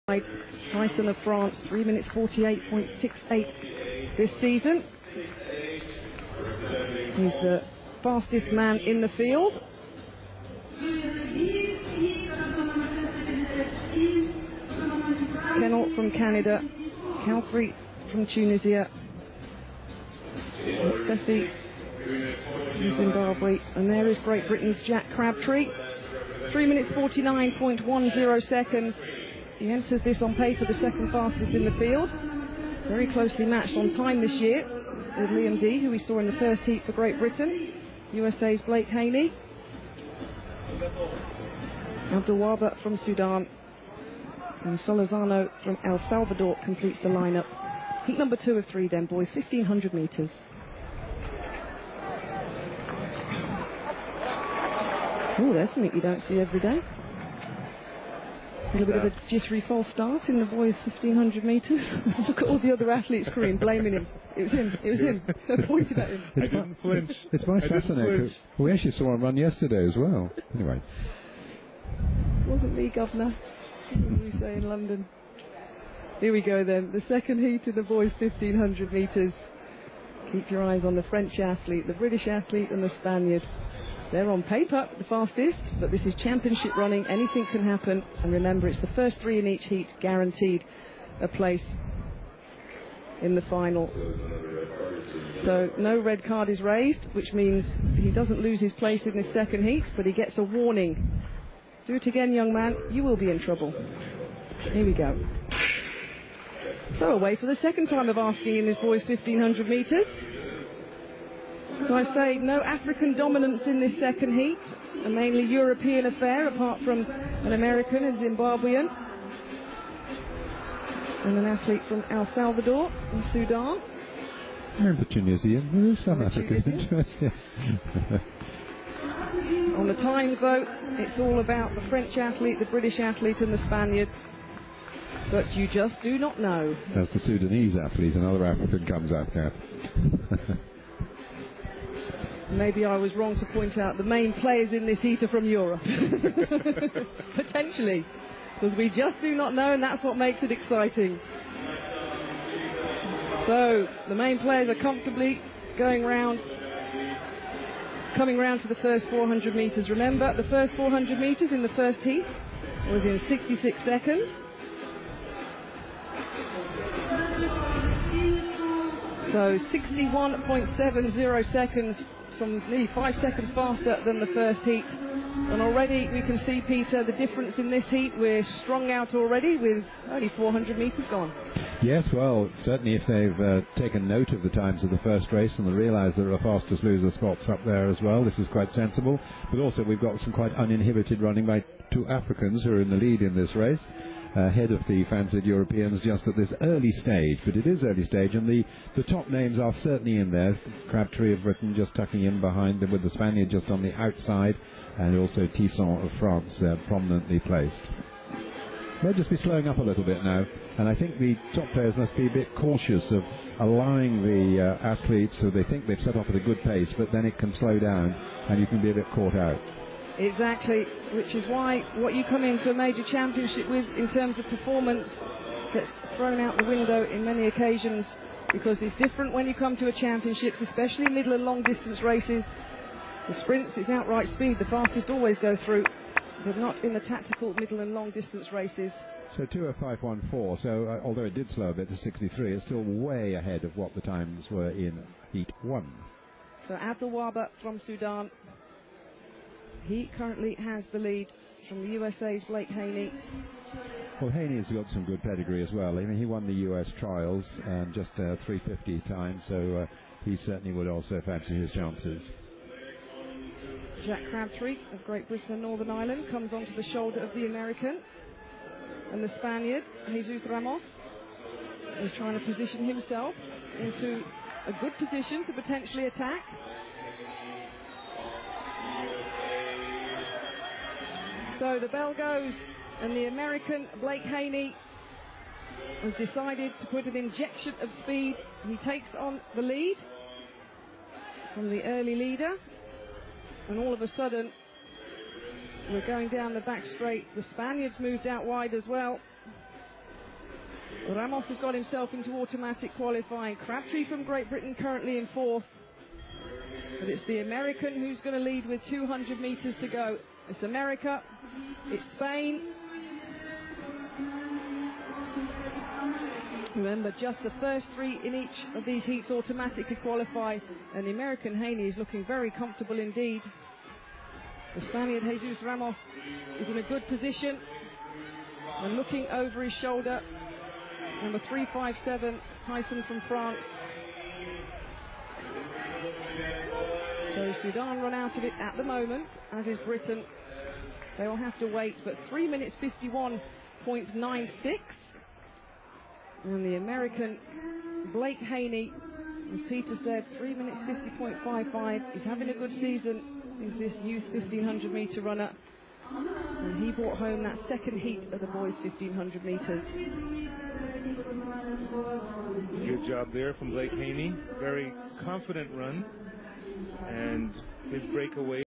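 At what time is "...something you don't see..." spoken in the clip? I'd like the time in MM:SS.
00:55.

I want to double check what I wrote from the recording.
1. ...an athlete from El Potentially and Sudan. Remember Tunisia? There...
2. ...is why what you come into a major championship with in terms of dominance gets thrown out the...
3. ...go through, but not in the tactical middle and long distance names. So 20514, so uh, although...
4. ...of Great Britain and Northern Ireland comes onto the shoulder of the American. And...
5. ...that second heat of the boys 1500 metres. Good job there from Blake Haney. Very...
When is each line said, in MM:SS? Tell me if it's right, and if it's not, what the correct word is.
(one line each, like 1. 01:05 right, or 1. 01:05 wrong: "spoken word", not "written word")
1. 02:01 wrong: "Salvador", not "Potentially"
2. 03:41 wrong: "performance", not "dominance"
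3. 03:55 wrong: "races", not "names"
4. 04:24 right
5. 05:57 right.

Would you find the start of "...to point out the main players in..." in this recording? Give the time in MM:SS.
02:23.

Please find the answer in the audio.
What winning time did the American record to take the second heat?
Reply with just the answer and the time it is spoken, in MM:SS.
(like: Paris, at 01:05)
3 minutes 50.55, at 05:50.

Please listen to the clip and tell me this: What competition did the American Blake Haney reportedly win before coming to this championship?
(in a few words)
US trials.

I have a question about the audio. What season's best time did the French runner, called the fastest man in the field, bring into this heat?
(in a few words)
3 minutes 48.68.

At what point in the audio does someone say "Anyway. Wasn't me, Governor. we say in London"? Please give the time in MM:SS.
01:10.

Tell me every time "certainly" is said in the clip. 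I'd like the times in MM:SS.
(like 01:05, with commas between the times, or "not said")
03:02, 03:19, 04:20.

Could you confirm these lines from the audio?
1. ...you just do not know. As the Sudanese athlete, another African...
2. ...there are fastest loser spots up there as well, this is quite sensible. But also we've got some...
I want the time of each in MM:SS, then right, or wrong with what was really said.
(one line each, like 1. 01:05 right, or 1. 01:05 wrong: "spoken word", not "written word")
1. 02:15 right
2. 03:06 right.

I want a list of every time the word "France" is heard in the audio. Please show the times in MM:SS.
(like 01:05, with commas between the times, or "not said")
00:01, 03:26, 05:33.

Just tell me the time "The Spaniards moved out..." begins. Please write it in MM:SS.
04:57.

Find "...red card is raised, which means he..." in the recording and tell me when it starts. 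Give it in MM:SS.
01:35.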